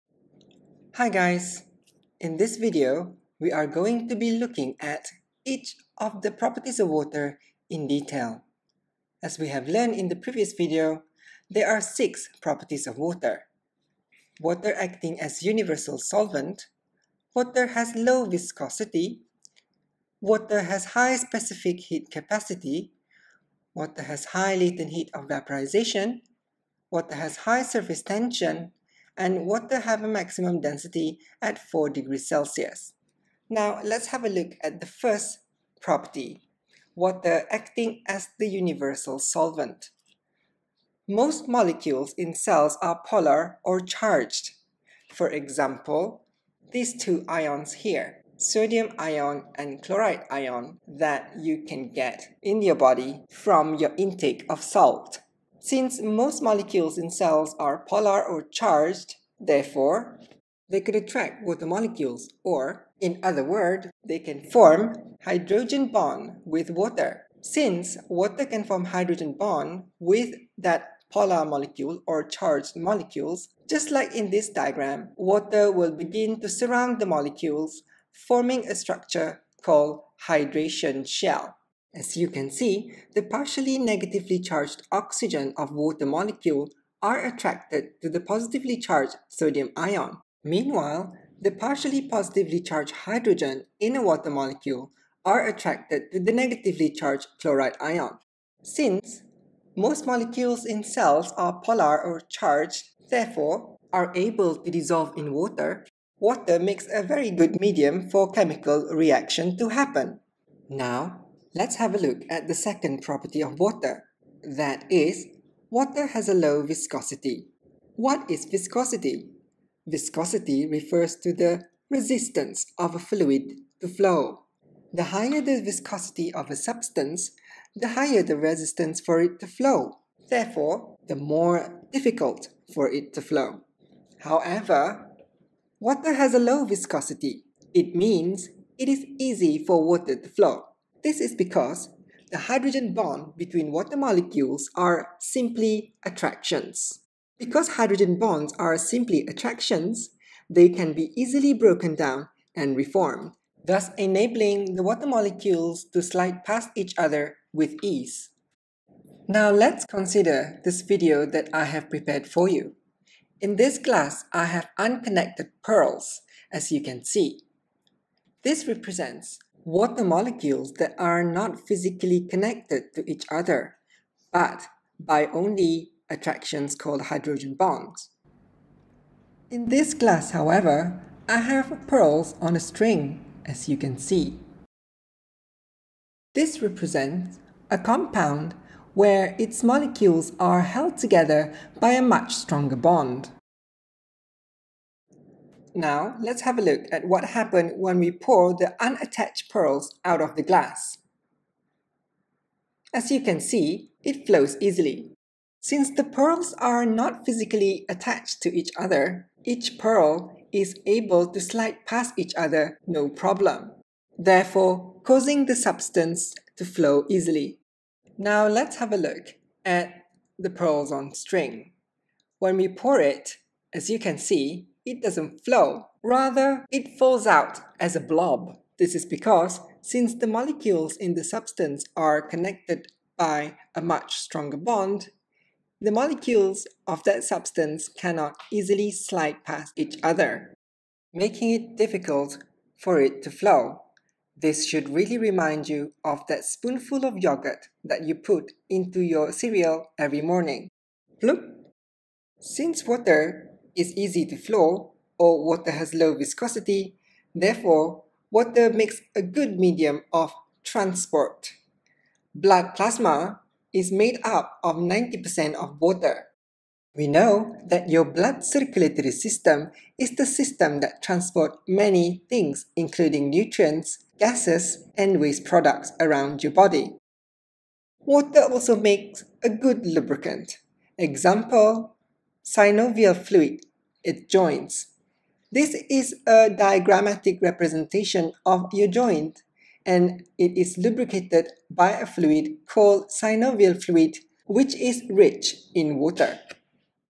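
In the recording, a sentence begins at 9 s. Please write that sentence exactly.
As we have learned in the previous video, there are six properties of water.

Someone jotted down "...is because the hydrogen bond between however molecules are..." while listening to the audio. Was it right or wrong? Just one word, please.
wrong.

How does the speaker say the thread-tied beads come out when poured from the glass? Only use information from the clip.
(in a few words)
As a blob.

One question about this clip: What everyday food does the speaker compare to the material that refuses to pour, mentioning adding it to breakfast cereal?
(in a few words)
Yogurt.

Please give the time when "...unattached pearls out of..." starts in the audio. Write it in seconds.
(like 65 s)
198 s.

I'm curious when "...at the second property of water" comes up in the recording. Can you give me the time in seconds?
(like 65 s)
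112 s.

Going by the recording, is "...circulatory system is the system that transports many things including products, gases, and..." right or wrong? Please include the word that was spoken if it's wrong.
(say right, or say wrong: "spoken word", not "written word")
wrong: "nutrients", not "products".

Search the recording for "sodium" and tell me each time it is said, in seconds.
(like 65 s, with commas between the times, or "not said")
48 s, 89 s.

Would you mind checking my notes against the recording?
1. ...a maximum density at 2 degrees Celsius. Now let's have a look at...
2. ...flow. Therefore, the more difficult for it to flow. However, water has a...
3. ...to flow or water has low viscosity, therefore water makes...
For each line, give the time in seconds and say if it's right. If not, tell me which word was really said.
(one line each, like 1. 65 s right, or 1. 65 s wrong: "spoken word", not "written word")
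1. 30 s wrong: "4", not "2"
2. 129 s right
3. 254 s right.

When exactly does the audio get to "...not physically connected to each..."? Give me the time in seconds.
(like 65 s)
171 s.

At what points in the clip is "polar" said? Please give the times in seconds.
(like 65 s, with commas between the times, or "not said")
43 s, 57 s, 71 s, 101 s.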